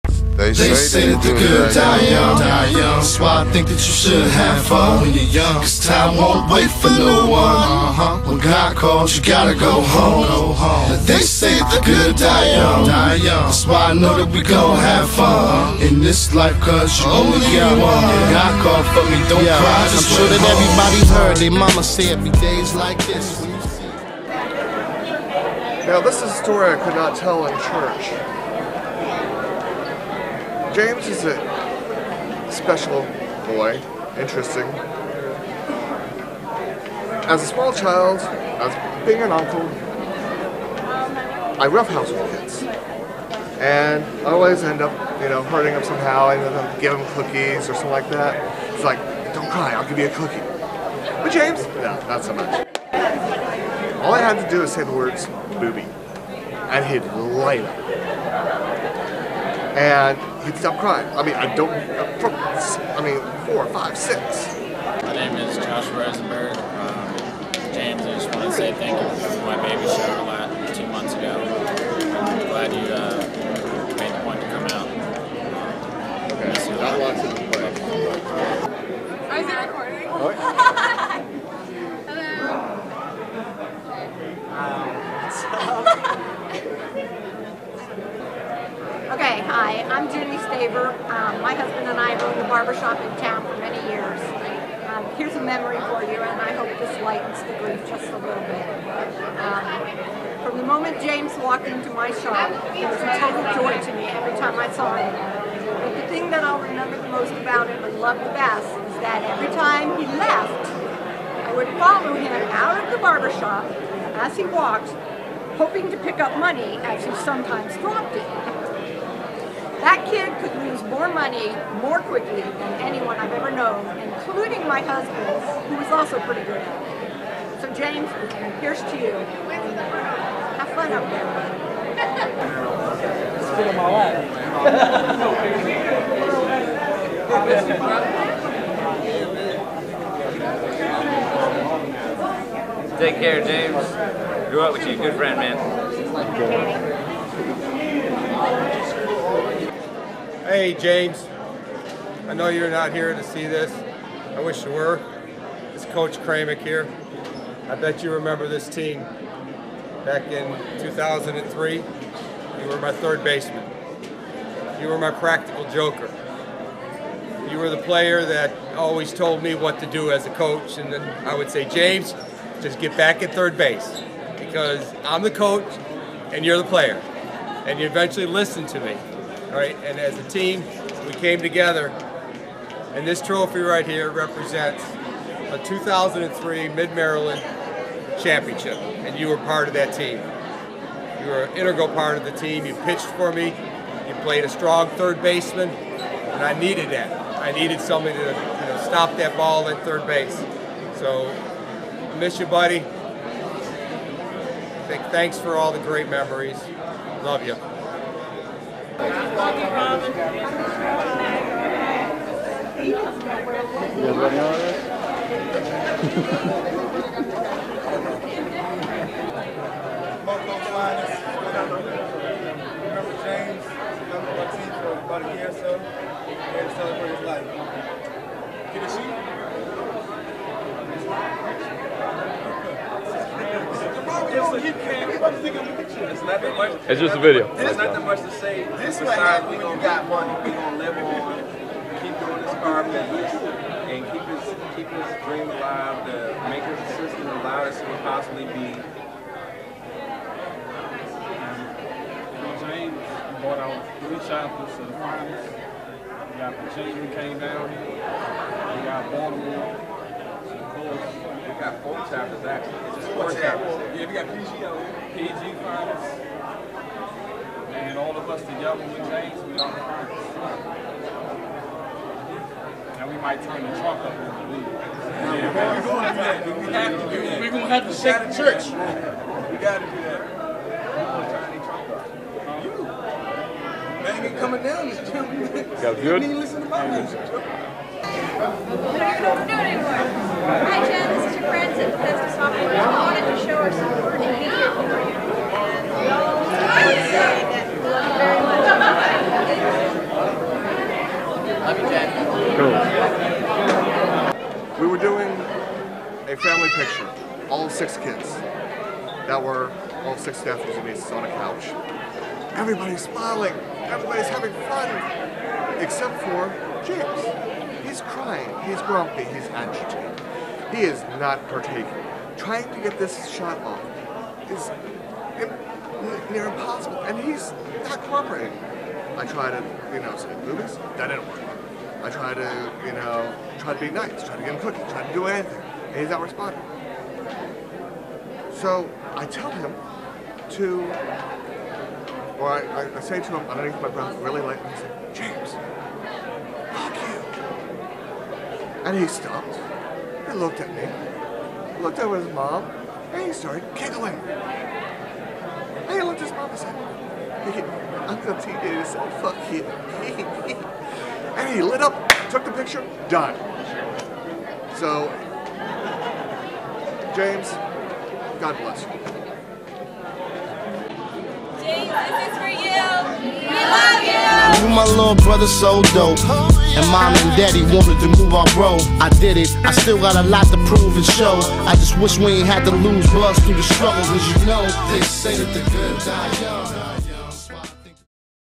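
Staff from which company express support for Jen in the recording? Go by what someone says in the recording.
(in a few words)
Bethesda Softworks.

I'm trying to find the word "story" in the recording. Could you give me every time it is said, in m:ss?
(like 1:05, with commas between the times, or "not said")
0:26.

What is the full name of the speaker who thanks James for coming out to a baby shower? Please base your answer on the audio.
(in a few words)
Josh Rosenberg.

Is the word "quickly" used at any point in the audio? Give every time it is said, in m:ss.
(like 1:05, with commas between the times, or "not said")
2:02.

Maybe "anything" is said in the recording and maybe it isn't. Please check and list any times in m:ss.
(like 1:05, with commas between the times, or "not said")
5:35.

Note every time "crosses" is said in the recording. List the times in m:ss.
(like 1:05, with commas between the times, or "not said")
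not said.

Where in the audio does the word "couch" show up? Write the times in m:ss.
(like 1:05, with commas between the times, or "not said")
5:11.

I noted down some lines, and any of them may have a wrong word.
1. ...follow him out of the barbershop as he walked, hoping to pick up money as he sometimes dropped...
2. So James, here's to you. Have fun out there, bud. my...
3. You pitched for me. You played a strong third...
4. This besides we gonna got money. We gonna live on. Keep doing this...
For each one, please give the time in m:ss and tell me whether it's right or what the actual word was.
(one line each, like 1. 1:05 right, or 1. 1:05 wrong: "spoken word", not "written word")
1. 1:51 right
2. 2:07 right
3. 3:12 right
4. 3:58 right.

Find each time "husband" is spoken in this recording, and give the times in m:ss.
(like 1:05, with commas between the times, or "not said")
1:31, 2:04.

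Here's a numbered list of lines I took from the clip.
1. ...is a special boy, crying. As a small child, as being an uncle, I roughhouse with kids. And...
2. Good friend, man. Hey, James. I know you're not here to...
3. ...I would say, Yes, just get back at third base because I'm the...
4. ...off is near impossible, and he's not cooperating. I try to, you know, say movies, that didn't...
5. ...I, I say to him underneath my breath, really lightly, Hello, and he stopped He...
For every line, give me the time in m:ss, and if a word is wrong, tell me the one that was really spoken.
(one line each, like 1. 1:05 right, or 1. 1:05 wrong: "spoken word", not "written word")
1. 0:31 wrong: "interesting", not "crying"
2. 2:24 right
3. 2:51 wrong: "James", not "Yes"
4. 5:23 right
5. 5:42 wrong: "James", not "Hello".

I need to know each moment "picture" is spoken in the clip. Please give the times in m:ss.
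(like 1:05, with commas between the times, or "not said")
5:06, 6:02.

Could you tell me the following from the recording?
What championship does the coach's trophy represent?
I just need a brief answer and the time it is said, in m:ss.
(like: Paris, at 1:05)
Mid-Maryland championship, at 3:06.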